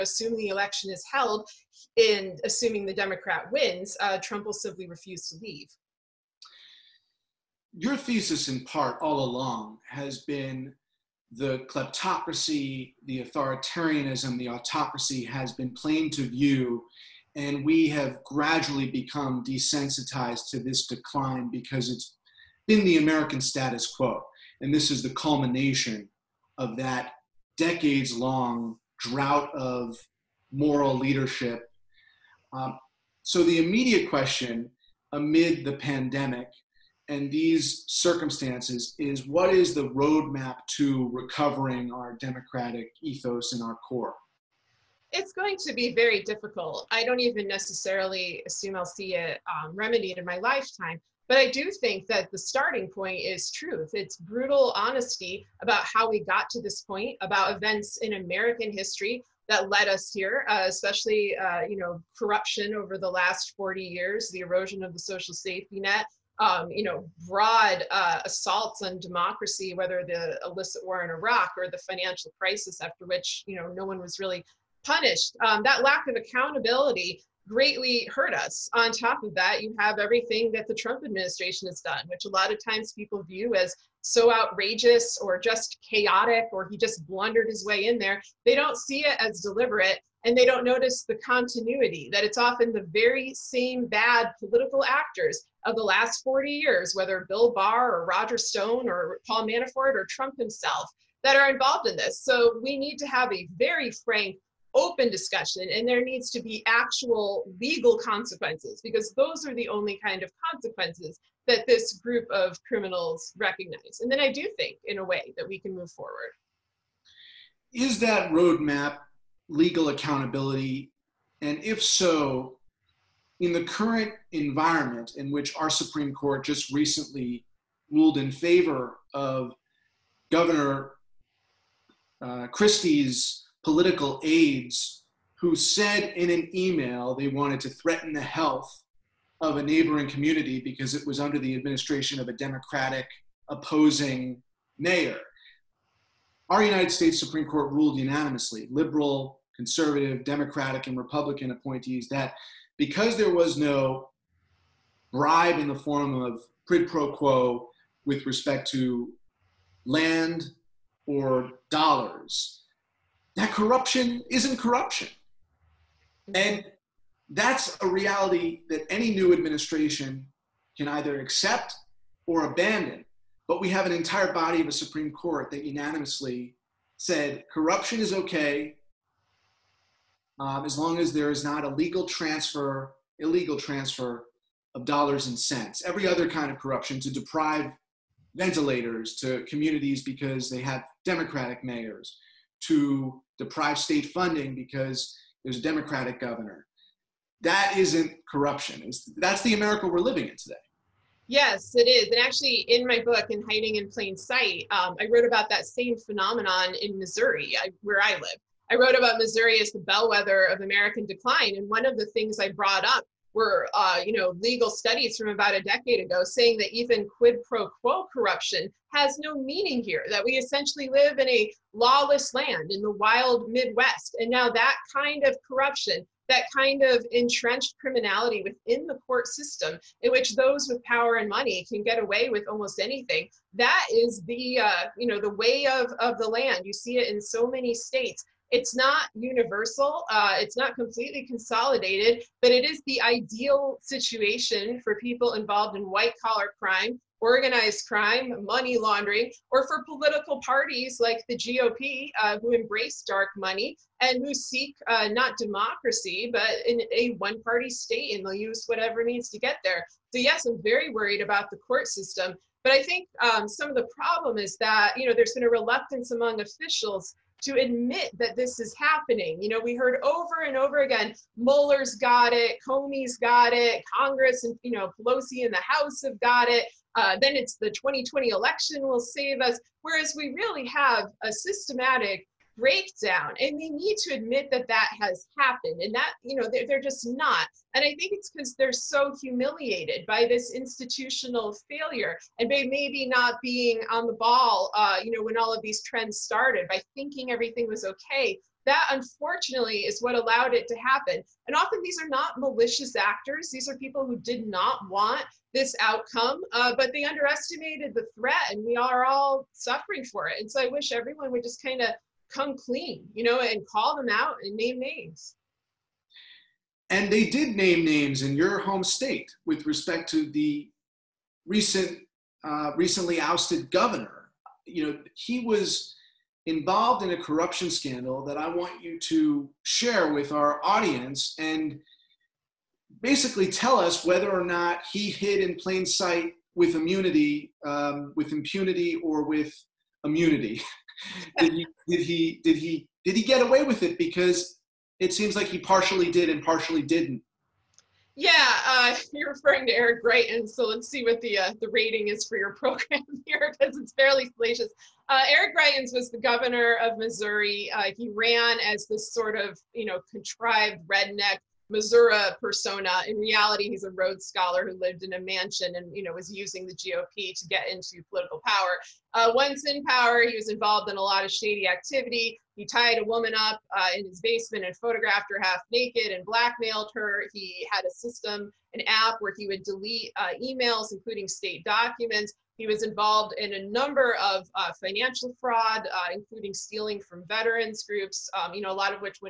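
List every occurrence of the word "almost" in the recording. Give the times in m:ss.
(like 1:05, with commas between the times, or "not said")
3:52.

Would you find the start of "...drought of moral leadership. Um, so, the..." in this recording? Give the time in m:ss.
0:28.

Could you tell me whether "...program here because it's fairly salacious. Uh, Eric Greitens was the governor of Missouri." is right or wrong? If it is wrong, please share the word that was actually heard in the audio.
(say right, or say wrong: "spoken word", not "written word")
right.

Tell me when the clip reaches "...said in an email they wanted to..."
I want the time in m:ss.
2:15.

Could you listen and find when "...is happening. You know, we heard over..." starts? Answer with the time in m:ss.
4:28.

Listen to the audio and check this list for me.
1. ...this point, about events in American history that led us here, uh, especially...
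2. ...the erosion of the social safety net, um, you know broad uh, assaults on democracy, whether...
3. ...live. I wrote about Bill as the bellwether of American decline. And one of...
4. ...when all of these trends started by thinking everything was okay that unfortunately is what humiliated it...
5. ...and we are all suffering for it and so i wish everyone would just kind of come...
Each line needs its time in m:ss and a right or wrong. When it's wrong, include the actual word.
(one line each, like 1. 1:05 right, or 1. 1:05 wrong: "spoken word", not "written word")
1. 0:56 right
2. 1:04 right
3. 3:28 wrong: "Missouri", not "Bill"
4. 4:55 wrong: "allowed", not "humiliated"
5. 5:08 right.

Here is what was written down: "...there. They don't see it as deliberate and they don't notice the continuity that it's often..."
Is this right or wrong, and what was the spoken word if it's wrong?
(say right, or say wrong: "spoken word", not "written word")
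right.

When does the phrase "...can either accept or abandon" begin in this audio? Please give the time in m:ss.
2:50.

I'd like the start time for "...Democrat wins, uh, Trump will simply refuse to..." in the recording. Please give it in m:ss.
0:02.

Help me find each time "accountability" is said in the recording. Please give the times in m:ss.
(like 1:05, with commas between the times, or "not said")
1:16, 1:59.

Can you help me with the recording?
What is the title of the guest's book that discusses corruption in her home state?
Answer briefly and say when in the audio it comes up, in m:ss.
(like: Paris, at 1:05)
Hiding in Plain Sight, at 3:23.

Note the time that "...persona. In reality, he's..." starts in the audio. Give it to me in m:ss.
6:02.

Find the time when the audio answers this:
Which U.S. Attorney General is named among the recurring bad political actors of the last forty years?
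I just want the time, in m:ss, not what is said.
1:37.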